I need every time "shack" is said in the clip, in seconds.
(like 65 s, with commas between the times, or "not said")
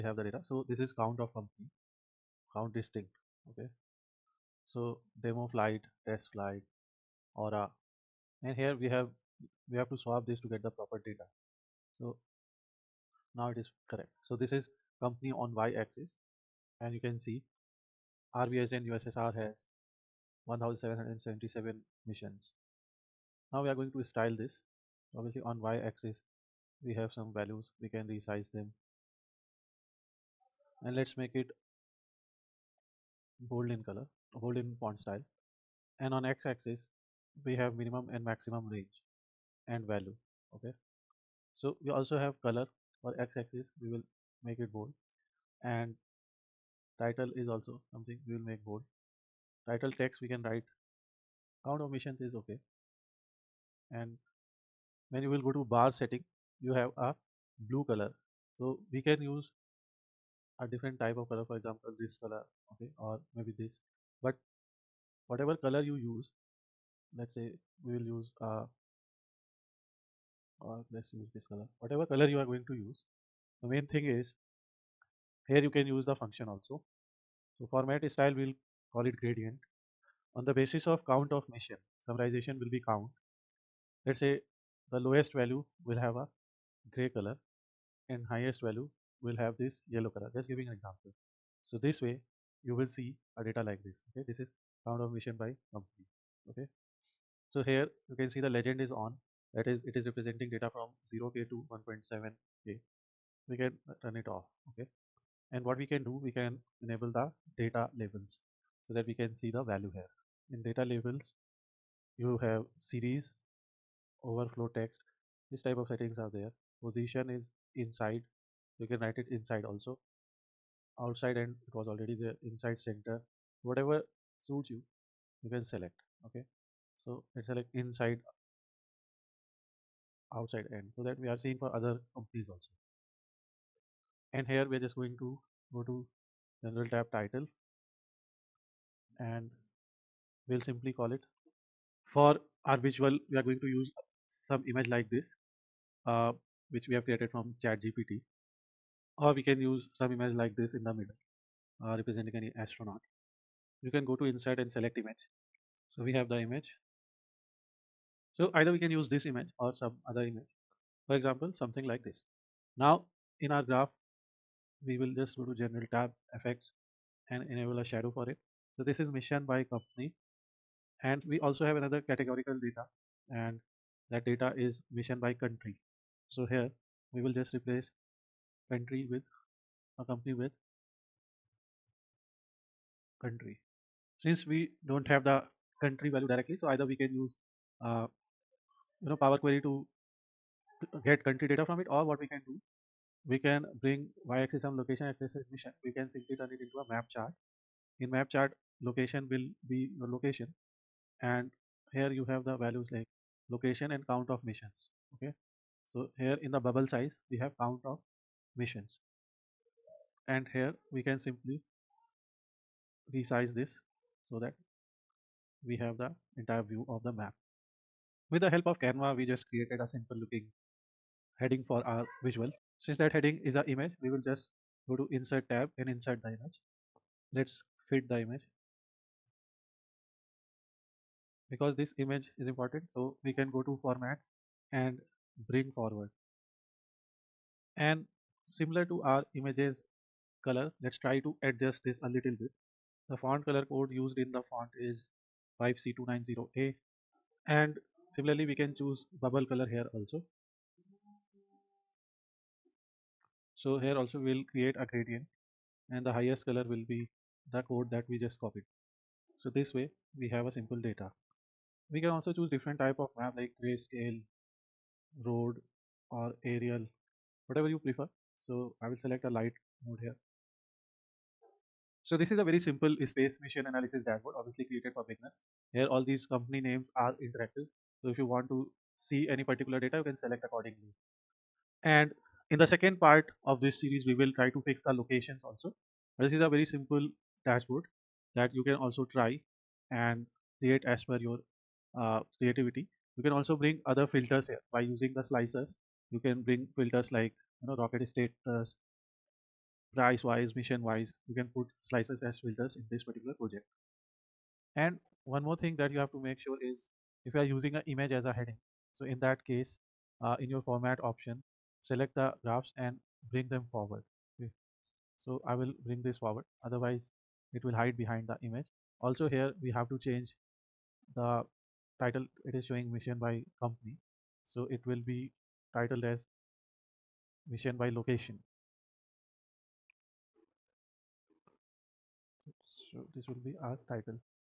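not said.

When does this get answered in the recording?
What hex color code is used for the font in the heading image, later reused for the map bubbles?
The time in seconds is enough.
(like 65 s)
245 s.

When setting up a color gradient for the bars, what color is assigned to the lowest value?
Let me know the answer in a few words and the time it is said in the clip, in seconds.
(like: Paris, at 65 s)
gray, at 86 s.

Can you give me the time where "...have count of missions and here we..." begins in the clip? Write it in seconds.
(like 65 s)
207 s.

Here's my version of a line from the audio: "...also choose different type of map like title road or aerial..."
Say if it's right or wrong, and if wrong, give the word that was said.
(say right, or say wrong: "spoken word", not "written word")
wrong: "grayscale", not "title".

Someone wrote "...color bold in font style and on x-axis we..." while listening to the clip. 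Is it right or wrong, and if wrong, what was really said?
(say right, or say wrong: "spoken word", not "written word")
right.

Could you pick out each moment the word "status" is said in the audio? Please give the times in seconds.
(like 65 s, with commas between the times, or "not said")
298 s.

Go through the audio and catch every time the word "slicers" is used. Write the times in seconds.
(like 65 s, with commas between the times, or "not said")
295 s, 301 s.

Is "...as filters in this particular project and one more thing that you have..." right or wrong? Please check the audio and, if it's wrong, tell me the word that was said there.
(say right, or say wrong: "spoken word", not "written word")
right.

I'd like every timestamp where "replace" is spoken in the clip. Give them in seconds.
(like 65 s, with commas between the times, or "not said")
177 s.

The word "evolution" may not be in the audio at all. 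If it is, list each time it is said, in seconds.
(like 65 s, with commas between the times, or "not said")
not said.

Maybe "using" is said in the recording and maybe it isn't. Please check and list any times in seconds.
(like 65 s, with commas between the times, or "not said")
294 s, 307 s.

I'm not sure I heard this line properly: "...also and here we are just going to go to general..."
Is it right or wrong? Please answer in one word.
right.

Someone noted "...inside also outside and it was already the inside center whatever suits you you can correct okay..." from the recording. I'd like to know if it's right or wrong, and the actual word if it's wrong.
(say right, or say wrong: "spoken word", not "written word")
wrong: "select", not "correct".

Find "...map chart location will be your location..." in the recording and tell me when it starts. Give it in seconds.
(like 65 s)
198 s.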